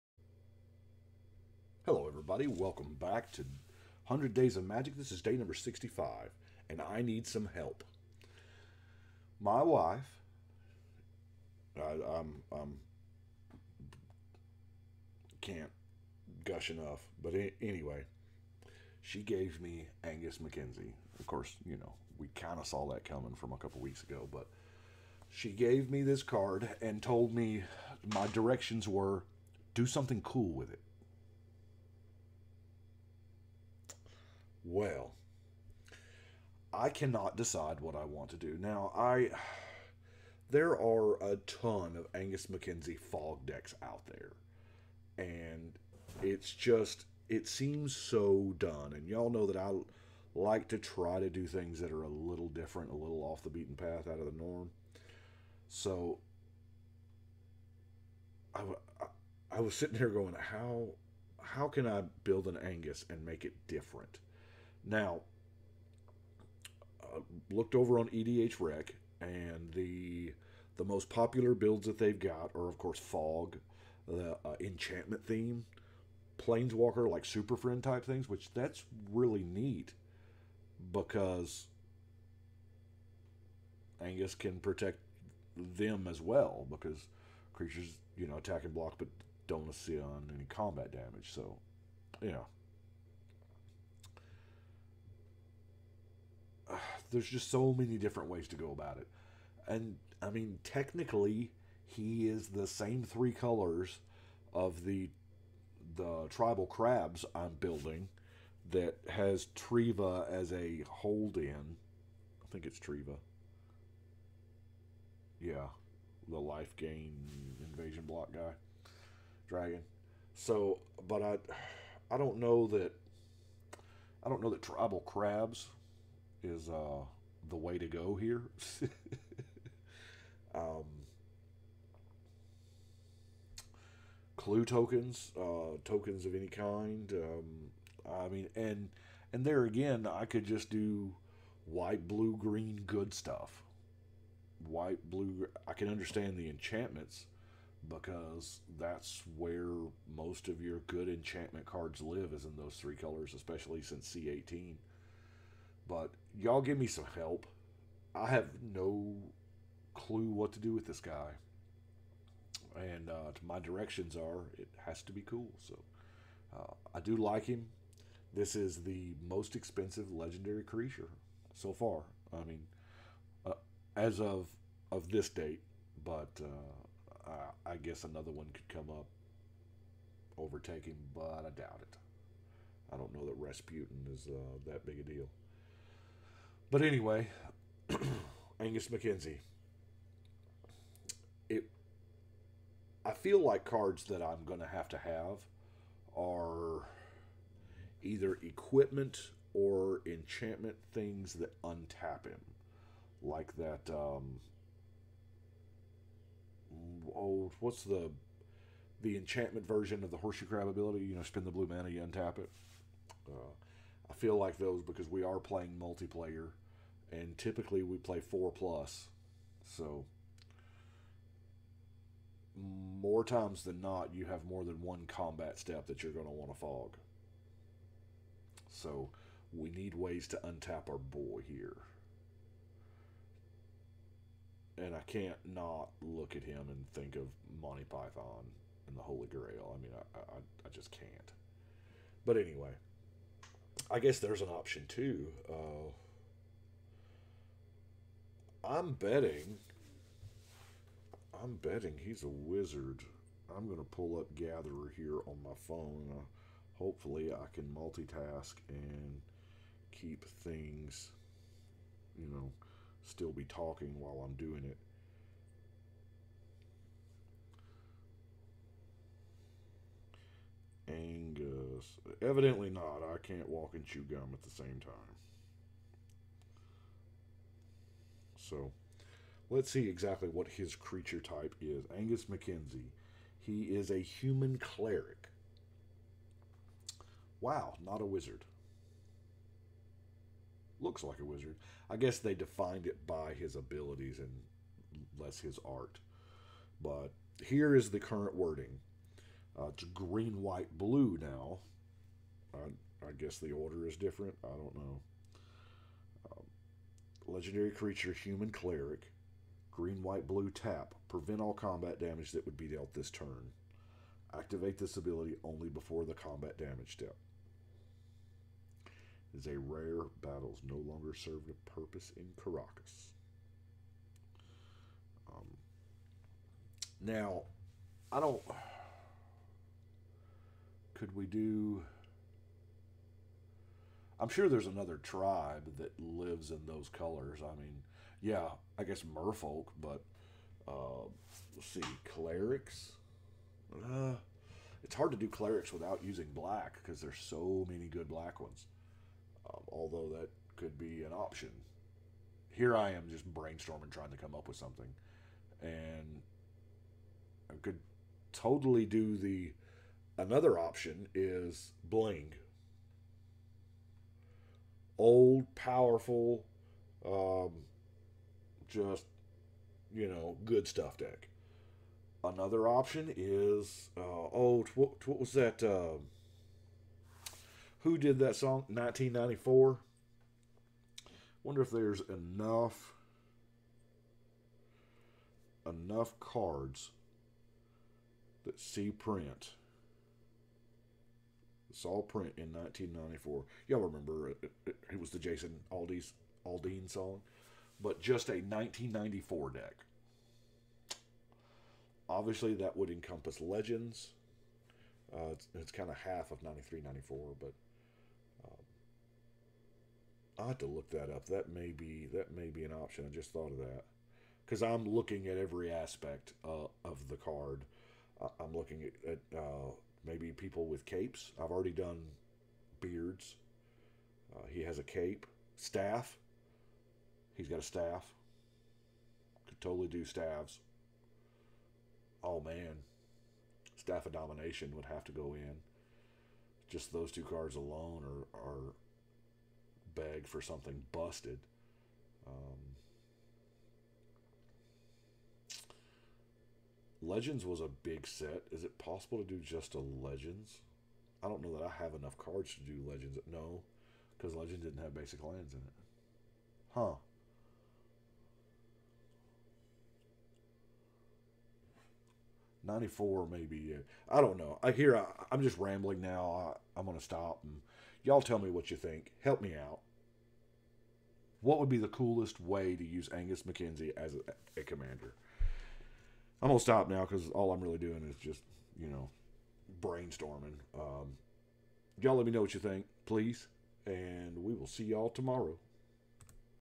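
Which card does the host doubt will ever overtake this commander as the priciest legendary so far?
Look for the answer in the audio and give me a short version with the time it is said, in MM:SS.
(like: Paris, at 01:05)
Rasputin, at 03:03.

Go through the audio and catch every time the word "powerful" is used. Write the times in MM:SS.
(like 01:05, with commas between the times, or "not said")
06:05.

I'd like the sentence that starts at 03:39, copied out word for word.
So more times than not, you have more than one combat step that you're going to want to fog.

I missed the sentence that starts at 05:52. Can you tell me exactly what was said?
Here I am just brainstorming, trying to come up with something, and I could totally do the.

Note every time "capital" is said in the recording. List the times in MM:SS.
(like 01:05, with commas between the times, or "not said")
not said.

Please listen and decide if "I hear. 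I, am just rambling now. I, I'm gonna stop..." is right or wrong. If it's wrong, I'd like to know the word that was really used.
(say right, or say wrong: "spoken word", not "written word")
right.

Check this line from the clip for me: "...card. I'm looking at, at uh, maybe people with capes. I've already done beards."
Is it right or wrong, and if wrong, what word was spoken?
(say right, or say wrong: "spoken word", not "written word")
right.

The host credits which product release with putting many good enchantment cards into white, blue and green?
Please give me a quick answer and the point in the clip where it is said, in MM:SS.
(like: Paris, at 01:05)
C18, at 02:34.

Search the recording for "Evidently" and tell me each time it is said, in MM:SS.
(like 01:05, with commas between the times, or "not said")
04:32.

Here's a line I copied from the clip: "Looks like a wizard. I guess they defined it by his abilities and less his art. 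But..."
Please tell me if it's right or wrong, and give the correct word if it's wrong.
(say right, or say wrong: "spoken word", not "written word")
right.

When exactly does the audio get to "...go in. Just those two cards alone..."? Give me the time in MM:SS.
07:15.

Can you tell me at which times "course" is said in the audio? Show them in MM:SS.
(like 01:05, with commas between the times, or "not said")
00:21, 01:12.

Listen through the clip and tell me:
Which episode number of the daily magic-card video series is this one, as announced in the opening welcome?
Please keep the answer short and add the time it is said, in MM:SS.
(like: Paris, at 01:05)
65, at 00:05.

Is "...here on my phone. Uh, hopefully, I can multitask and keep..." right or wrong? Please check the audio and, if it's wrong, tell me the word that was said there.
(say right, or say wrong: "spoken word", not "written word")
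right.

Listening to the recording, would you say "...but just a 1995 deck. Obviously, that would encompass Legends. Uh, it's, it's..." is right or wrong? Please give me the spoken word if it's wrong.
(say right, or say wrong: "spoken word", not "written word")
wrong: "1994", not "1995".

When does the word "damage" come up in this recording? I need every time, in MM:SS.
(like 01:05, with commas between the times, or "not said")
01:30, 05:11, 05:16.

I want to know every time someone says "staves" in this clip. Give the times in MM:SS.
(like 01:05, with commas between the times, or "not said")
07:10.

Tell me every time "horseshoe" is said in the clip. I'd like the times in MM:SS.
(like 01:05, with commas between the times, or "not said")
03:30.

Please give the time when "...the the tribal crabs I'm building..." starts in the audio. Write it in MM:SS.
01:44.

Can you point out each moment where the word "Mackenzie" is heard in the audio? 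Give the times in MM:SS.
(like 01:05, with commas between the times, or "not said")
00:20, 00:42, 04:42, 07:53.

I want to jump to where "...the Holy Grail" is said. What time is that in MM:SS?
03:58.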